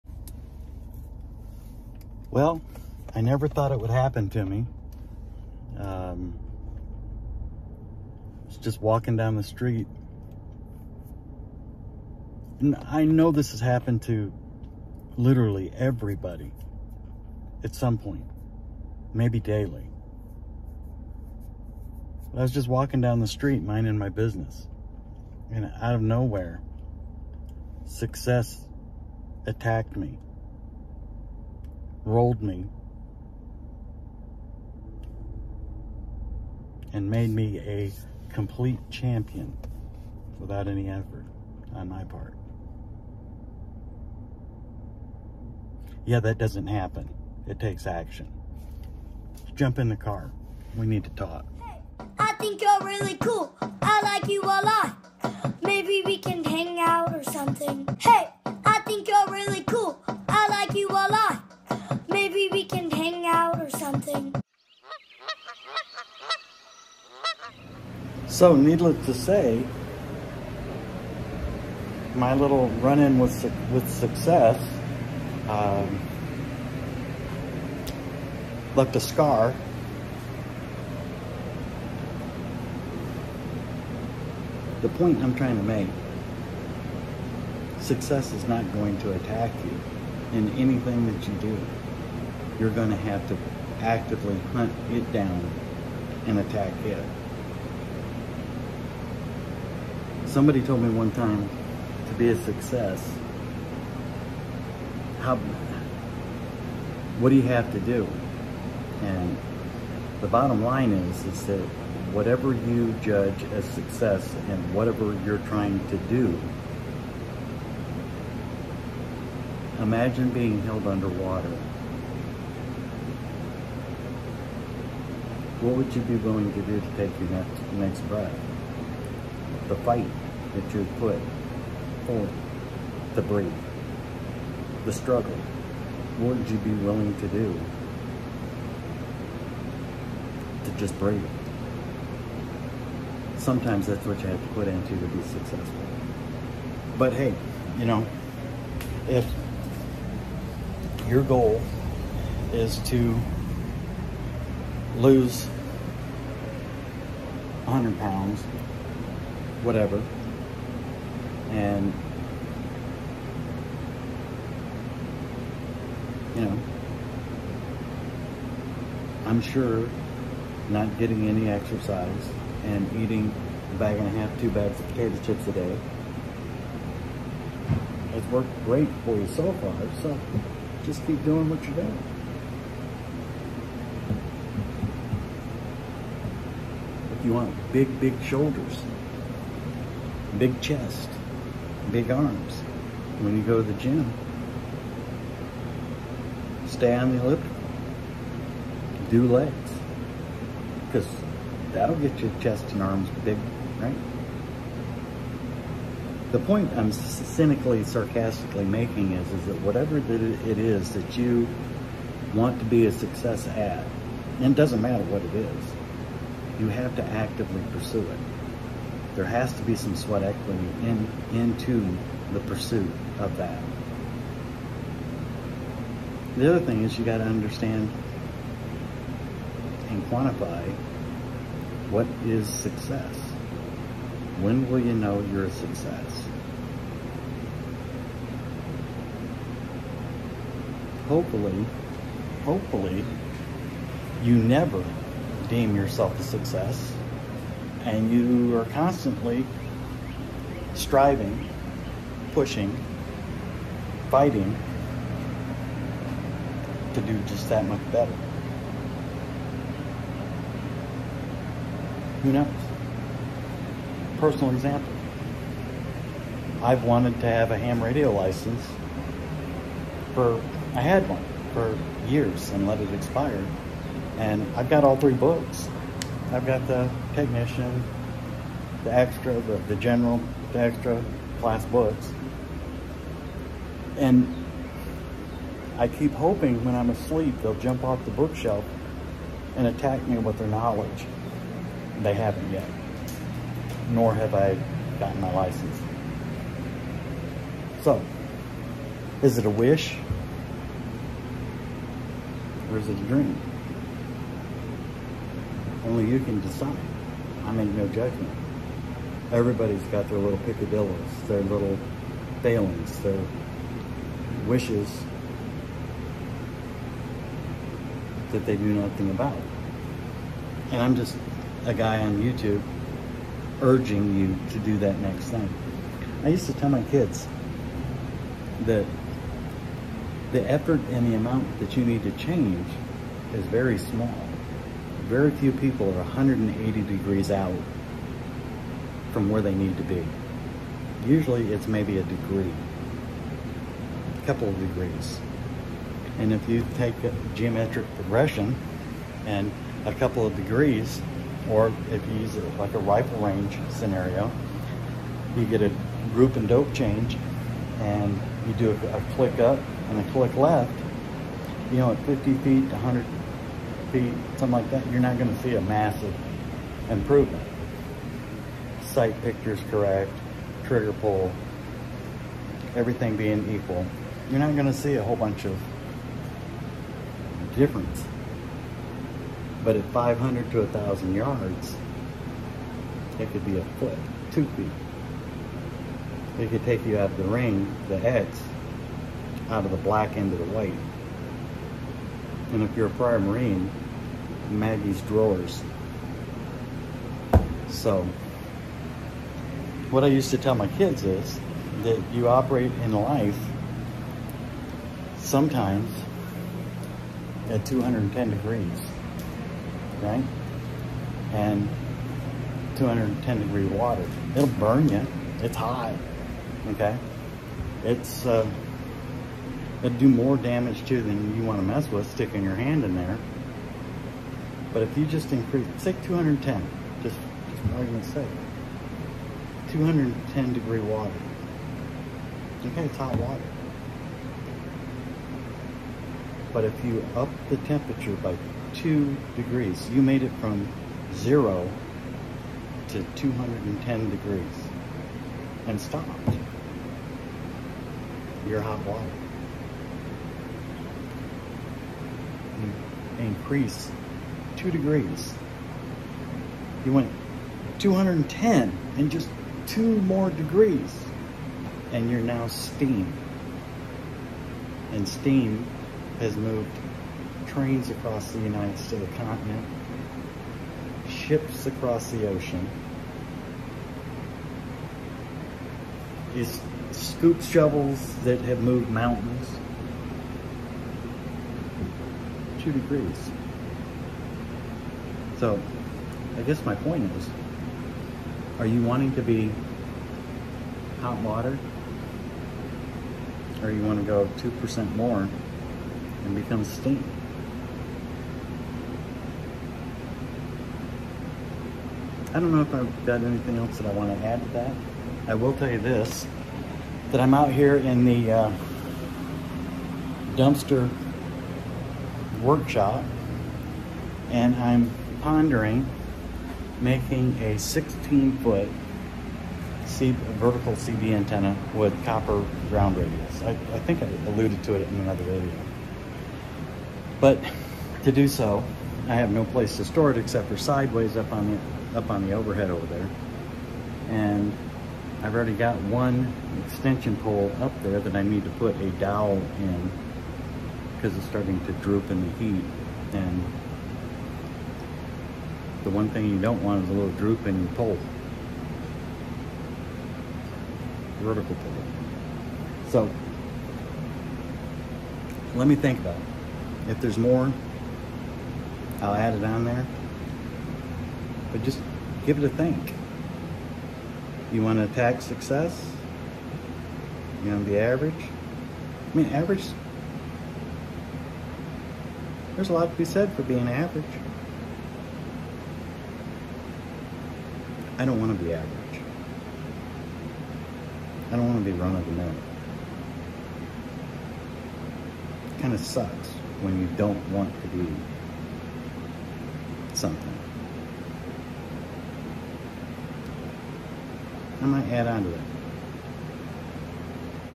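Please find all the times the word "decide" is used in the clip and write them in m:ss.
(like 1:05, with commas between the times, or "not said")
5:06.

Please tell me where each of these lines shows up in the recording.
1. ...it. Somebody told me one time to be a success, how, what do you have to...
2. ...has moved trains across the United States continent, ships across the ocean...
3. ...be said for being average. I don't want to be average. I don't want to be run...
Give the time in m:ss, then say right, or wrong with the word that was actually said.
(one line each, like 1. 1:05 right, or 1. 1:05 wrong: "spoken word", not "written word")
1. 1:36 right
2. 7:46 right
3. 9:32 right.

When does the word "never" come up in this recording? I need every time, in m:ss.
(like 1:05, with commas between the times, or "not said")
0:03, 4:04.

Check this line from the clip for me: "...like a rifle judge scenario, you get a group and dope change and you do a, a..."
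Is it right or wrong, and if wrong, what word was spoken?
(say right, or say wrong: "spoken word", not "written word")
wrong: "range", not "judge".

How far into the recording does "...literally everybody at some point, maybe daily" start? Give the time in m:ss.
0:15.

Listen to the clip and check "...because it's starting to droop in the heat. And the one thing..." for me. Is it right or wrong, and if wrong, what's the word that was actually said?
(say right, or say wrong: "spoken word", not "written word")
right.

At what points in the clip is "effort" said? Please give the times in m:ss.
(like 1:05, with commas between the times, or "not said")
0:40, 5:30.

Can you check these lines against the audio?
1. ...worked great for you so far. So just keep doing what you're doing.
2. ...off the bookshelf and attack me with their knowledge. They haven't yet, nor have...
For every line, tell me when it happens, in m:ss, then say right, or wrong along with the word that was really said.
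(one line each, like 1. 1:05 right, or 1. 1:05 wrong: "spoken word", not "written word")
1. 2:58 right
2. 4:47 right.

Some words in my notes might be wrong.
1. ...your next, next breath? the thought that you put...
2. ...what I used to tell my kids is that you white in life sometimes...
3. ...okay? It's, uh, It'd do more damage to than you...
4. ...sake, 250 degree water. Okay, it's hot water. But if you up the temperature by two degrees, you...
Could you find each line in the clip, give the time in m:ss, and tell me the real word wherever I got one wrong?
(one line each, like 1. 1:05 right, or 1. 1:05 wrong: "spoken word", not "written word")
1. 2:07 wrong: "fight", not "thought"
2. 6:39 wrong: "operate", not "white"
3. 6:56 right
4. 7:08 wrong: "210", not "250".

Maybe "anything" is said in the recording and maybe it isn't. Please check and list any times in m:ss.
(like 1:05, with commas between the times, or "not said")
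1:30, 8:23.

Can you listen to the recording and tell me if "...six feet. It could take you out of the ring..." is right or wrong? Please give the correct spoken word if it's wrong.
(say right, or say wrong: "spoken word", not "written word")
wrong: "two", not "six".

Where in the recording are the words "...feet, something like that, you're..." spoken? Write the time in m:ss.
6:03.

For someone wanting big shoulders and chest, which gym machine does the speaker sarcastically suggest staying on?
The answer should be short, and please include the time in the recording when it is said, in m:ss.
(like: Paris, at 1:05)
elliptical, at 3:17.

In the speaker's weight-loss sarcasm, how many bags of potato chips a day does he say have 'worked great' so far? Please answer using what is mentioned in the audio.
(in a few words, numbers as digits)
2.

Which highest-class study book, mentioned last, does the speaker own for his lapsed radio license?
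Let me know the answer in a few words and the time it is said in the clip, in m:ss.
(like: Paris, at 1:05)
extra class, at 4:40.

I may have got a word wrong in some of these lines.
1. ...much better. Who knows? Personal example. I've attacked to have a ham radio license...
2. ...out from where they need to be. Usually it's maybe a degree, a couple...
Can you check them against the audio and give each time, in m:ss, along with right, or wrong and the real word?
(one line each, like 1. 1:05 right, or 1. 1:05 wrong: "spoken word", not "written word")
1. 4:17 wrong: "wanted", not "attacked"
2. 5:37 right.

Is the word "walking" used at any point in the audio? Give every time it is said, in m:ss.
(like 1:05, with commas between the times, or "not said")
0:08, 0:22.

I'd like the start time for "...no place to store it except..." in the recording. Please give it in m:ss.
8:49.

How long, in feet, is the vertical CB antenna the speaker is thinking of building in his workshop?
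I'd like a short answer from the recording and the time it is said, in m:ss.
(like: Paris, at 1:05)
16 feet, at 8:37.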